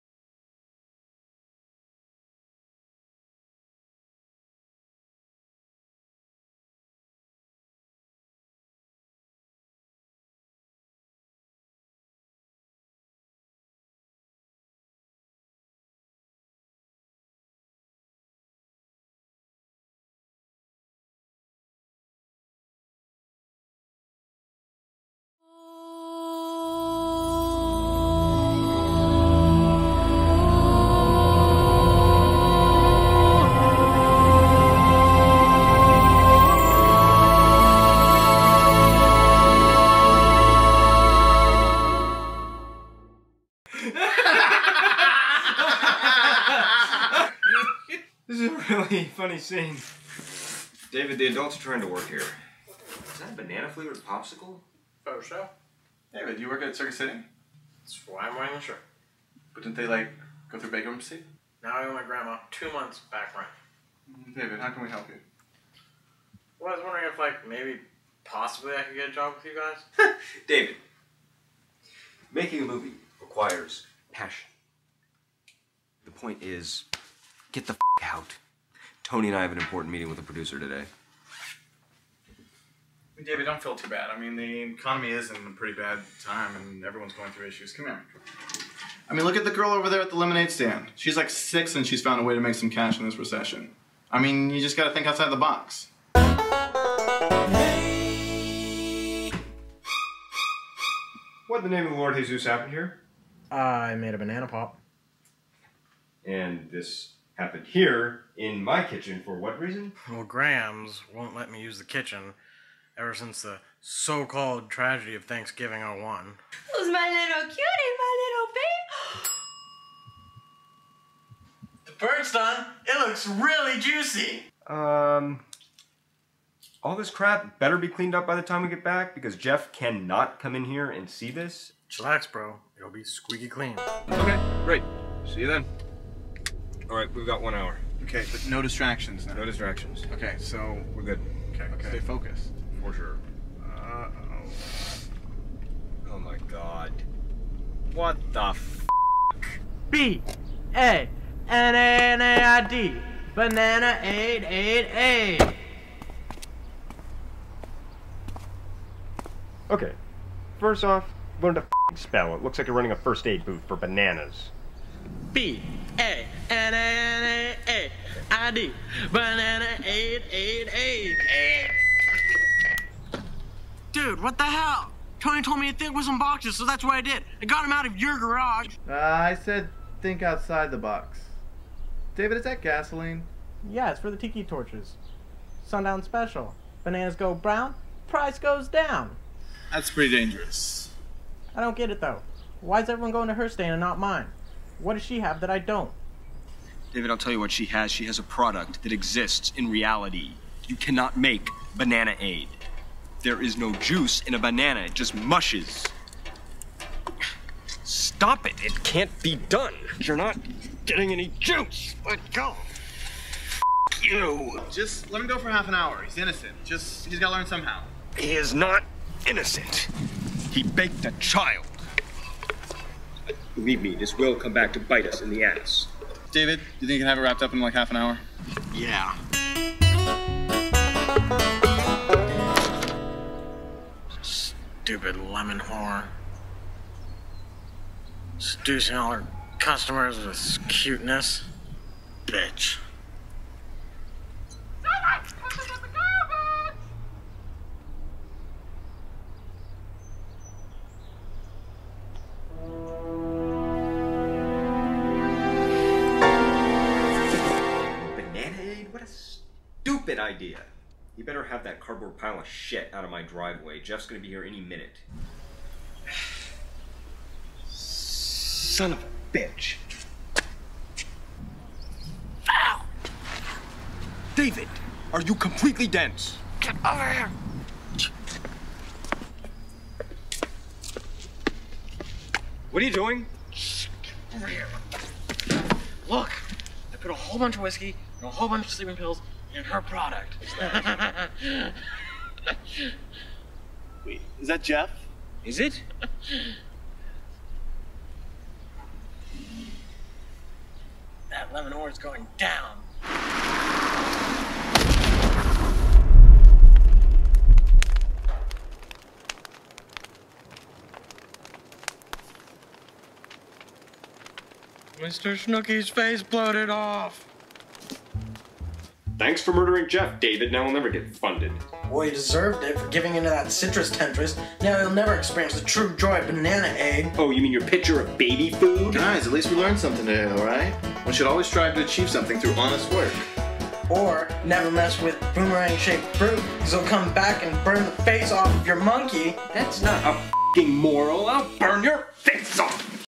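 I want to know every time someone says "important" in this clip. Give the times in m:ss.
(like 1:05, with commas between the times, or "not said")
1:19.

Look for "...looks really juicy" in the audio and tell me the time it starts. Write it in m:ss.
2:03.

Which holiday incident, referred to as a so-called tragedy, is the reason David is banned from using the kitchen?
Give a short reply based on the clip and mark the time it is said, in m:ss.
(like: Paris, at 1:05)
Thanksgiving 01, at 1:55.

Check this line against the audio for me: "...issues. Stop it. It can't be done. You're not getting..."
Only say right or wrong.
wrong.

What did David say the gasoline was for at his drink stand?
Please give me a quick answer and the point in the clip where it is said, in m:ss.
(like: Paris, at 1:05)
tiki torches, at 3:04.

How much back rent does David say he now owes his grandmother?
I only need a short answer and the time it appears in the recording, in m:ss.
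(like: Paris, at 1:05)
two months, at 1:02.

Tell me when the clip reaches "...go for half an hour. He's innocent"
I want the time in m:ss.
3:35.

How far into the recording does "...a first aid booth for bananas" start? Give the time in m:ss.
2:42.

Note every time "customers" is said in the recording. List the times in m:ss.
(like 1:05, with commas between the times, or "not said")
3:59.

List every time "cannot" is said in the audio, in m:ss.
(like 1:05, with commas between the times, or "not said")
2:09, 3:20.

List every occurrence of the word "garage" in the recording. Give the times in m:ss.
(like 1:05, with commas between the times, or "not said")
2:58.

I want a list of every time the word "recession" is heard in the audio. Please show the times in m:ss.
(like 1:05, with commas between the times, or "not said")
1:33.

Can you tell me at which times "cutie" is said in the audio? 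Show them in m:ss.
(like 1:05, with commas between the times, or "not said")
1:57.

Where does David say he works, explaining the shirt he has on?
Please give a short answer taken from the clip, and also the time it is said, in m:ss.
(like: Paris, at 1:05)
Circus City, at 0:56.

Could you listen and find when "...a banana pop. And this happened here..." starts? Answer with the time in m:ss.
1:44.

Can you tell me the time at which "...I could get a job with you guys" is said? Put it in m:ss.
1:08.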